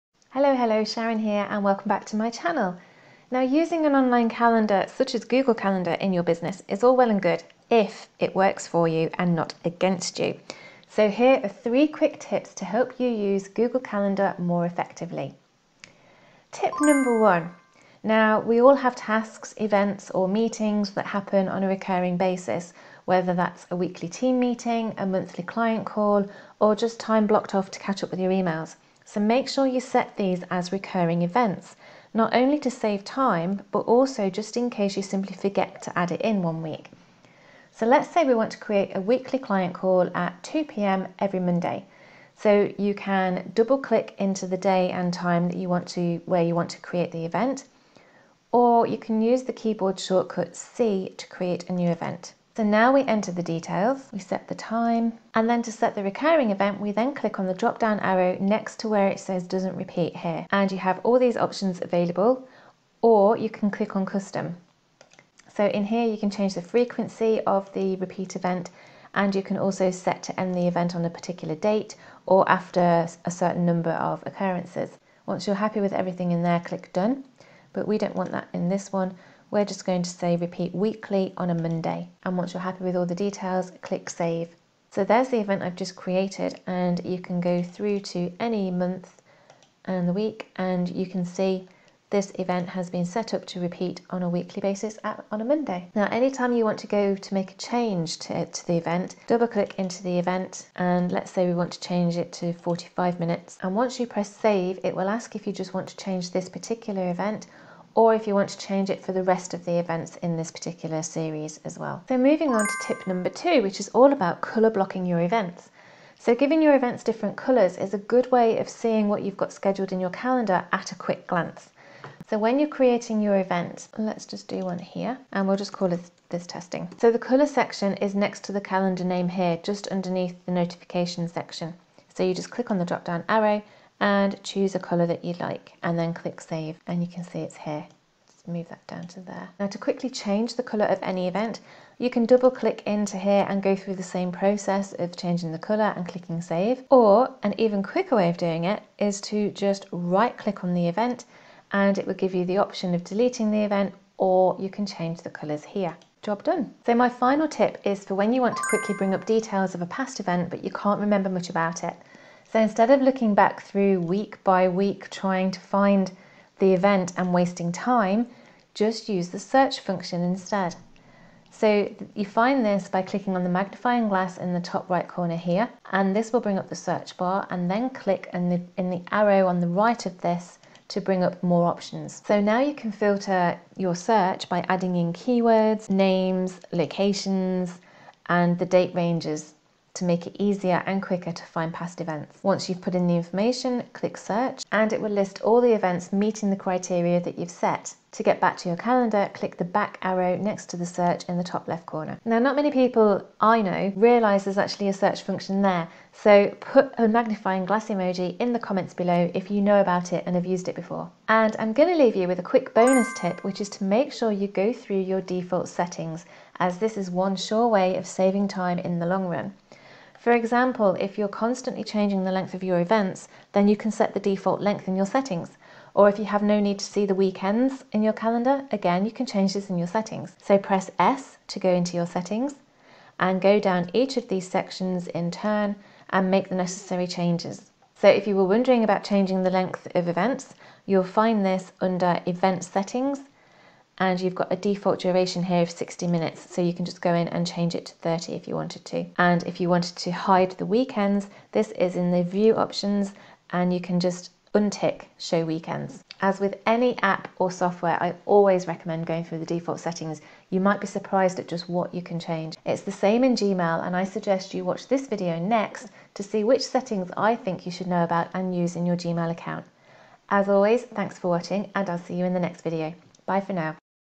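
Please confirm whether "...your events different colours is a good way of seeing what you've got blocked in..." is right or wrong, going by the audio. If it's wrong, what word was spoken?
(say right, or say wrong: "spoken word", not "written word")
wrong: "scheduled", not "blocked".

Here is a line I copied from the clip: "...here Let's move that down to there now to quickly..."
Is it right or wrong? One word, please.
right.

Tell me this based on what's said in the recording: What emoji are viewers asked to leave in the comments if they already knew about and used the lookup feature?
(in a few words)
magnifying glass emoji.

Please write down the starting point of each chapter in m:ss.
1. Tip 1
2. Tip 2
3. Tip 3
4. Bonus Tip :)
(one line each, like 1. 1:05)
1. 0:17
2. 1:52
3. 2:37
4. 3:32.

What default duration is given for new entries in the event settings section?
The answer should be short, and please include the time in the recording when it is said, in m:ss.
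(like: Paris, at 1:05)
60 minutes, at 4:05.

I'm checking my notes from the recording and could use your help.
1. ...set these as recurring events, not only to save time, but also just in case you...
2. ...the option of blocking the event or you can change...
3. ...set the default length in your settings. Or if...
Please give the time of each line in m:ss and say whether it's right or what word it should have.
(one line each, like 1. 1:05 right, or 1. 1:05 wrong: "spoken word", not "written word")
1. 0:29 right
2. 2:32 wrong: "deleting", not "blocking"
3. 3:43 right.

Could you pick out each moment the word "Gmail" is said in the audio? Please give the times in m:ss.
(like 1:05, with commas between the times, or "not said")
4:23, 4:28.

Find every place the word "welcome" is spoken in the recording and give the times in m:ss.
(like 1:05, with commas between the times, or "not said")
0:01.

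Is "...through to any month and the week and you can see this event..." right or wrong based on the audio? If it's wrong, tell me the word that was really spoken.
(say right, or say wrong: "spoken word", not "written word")
right.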